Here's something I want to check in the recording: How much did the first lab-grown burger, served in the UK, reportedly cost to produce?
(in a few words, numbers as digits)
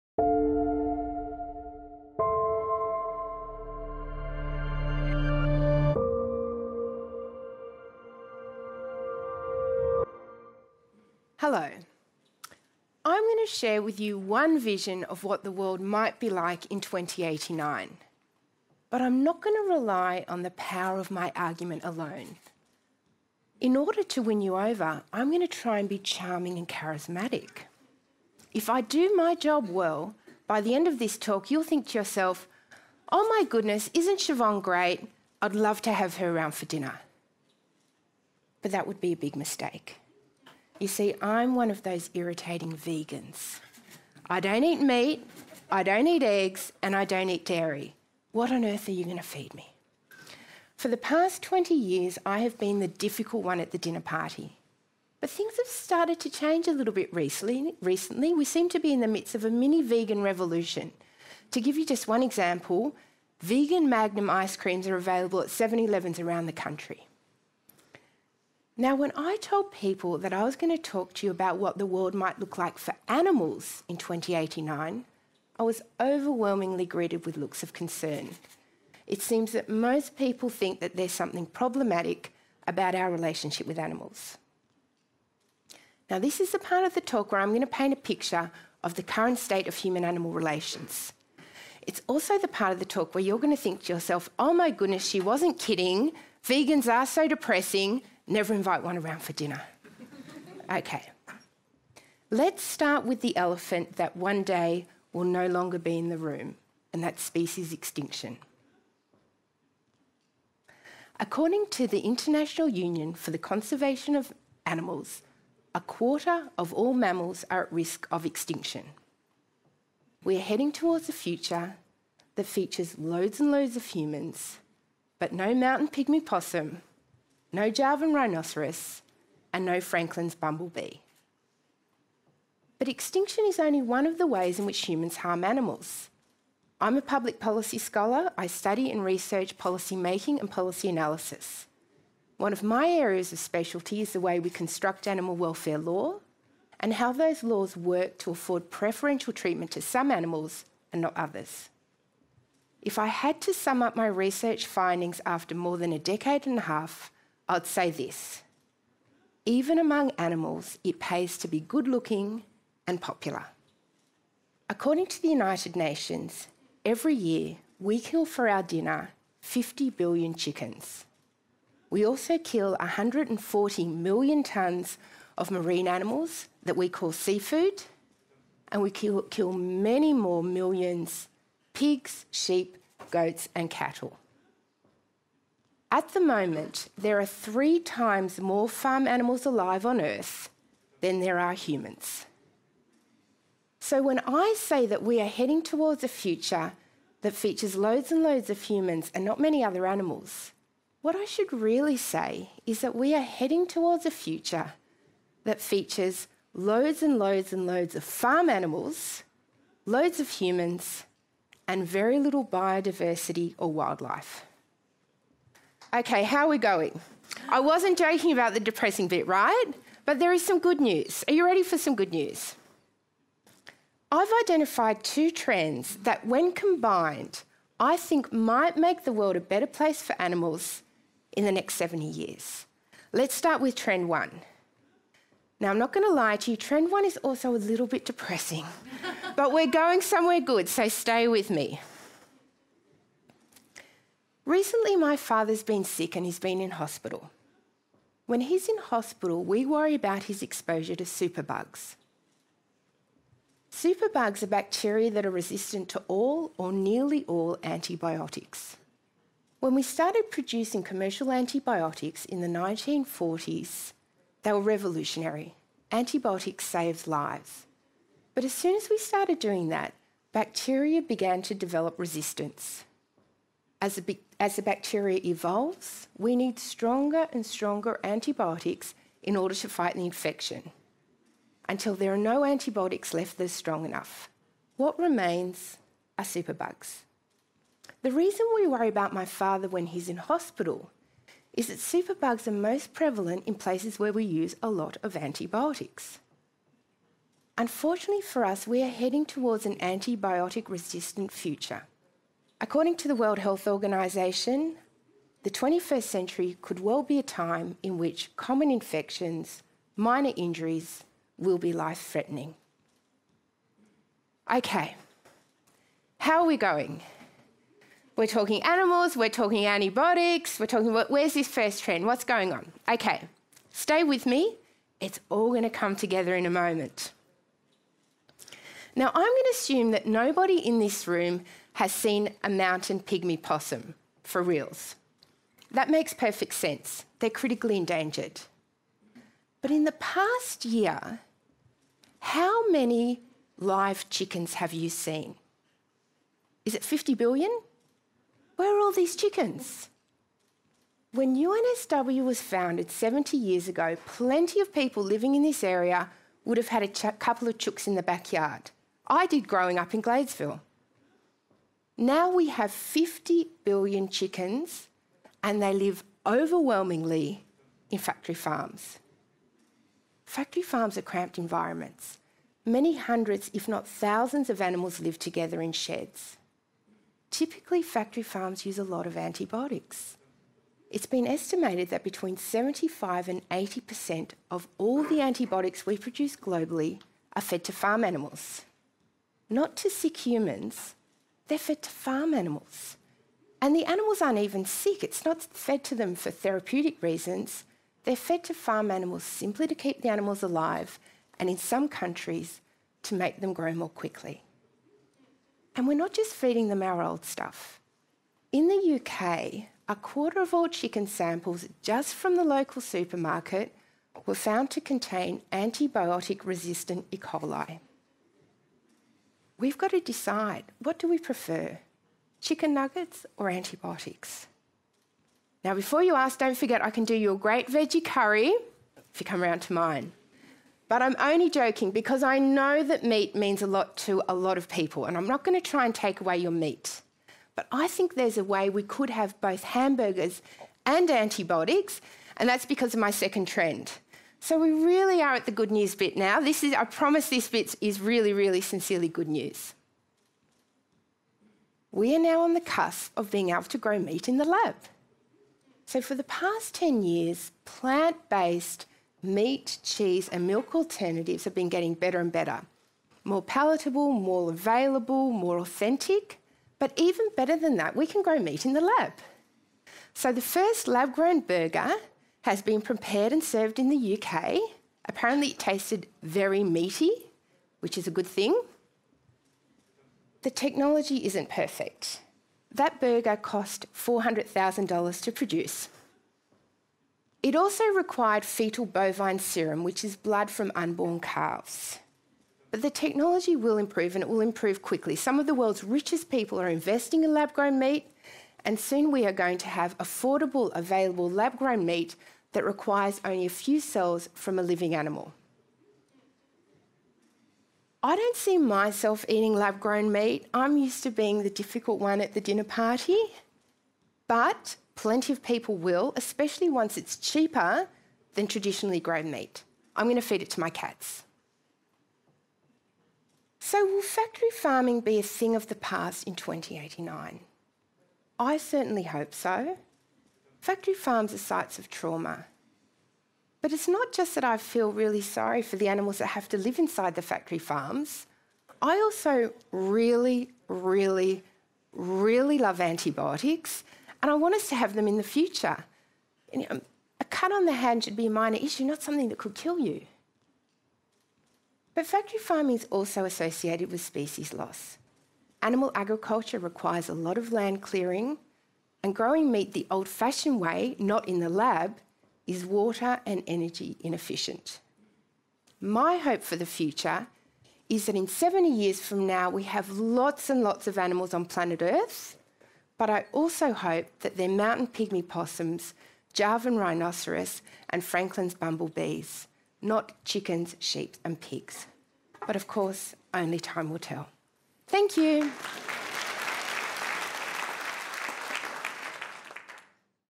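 $400,000.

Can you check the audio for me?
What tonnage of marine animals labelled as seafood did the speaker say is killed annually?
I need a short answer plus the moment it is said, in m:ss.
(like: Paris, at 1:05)
140 million tonnes, at 2:52.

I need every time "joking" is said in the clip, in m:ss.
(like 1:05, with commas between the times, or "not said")
3:37, 7:11.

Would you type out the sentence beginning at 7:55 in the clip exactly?
Apparently, it tasted very meaty, which is a good thing.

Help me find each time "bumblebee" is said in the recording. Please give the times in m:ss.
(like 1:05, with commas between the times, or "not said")
2:10, 9:38.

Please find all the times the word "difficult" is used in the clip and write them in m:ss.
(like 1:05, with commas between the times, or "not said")
0:52, 8:31.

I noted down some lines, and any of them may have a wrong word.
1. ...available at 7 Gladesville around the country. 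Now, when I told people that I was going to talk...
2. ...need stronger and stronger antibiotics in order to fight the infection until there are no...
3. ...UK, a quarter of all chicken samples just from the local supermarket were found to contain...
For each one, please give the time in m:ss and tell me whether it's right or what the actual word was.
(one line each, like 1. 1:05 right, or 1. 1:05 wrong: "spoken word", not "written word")
1. 1:04 wrong: "Elevens", not "Gladesville"
2. 4:36 right
3. 6:48 right.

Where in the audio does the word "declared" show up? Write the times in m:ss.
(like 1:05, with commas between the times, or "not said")
not said.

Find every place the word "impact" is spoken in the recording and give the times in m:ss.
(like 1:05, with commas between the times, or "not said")
not said.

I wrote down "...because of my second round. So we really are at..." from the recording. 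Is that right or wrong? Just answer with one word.
wrong.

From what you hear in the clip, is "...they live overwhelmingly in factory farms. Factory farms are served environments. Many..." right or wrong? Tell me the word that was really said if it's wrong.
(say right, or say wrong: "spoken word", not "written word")
wrong: "cramped", not "served".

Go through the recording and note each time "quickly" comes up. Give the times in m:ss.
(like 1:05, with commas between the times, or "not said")
6:43, 8:14.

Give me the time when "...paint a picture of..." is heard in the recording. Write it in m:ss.
1:27.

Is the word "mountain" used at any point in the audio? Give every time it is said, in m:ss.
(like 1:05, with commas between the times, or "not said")
2:05, 5:32, 9:34.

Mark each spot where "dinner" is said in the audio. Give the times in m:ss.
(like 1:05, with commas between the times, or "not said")
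0:36, 0:53, 1:39, 2:48, 8:32.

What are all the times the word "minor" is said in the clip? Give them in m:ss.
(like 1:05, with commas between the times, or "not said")
5:09, 9:08.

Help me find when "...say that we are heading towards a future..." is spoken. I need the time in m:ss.
3:14.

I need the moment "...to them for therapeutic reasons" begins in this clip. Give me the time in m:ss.
6:35.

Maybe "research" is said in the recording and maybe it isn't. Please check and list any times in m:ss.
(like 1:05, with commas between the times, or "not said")
2:19, 2:34.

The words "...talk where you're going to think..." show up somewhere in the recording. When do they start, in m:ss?
1:32.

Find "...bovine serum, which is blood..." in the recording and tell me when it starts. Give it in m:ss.
8:08.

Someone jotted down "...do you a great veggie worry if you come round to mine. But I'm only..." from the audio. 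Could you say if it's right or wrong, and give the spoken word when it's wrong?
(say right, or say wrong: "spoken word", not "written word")
wrong: "curry", not "worry".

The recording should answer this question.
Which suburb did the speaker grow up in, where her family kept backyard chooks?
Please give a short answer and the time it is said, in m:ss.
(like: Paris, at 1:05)
Gladesville, at 6:00.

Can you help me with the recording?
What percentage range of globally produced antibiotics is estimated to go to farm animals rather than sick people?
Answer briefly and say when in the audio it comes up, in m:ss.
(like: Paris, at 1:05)
75 to 80%, at 6:22.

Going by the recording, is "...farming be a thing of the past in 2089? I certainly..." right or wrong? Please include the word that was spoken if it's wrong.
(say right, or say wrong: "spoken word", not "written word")
right.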